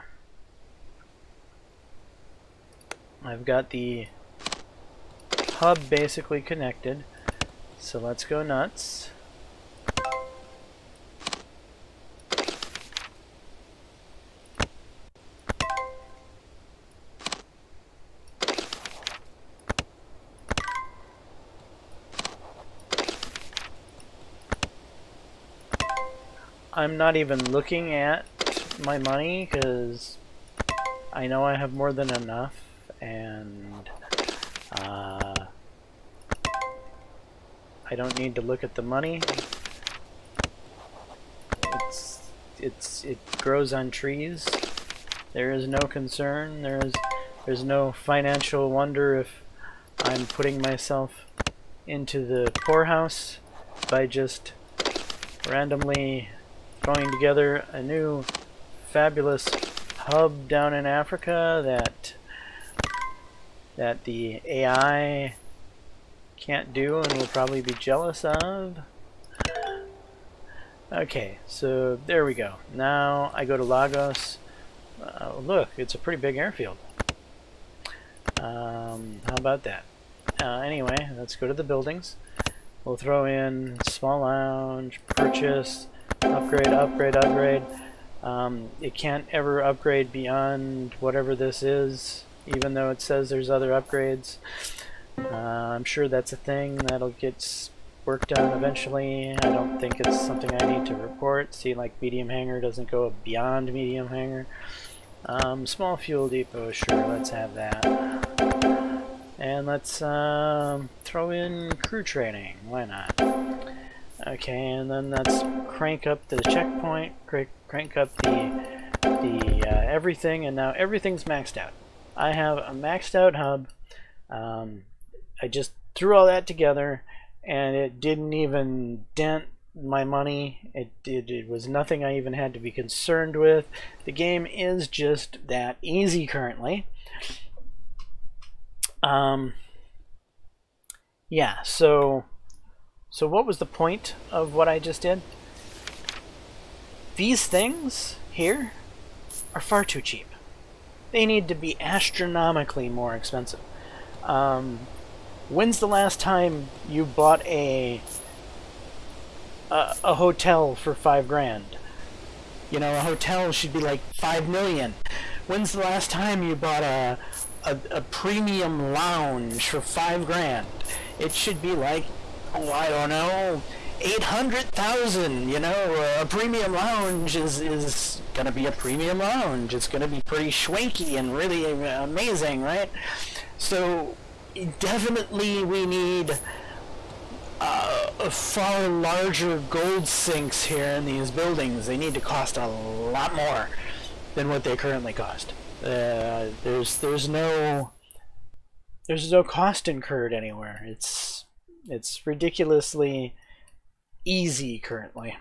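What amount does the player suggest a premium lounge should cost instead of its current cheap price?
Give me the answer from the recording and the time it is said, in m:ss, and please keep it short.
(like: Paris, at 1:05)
800,000, at 2:54.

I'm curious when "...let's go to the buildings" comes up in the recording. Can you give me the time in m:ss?
1:21.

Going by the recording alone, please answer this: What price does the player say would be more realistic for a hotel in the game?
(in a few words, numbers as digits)
5 million.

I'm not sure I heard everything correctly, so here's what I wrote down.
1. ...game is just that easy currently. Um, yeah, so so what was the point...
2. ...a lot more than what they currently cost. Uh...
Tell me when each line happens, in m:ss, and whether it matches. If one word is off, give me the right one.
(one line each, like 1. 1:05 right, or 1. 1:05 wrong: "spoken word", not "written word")
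1. 2:14 right
2. 3:12 right.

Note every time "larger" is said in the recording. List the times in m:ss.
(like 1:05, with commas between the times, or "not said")
3:08.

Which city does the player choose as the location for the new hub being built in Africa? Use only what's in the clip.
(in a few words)
Lagos.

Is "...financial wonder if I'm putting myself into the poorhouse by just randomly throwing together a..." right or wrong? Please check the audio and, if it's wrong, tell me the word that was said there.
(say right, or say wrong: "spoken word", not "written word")
right.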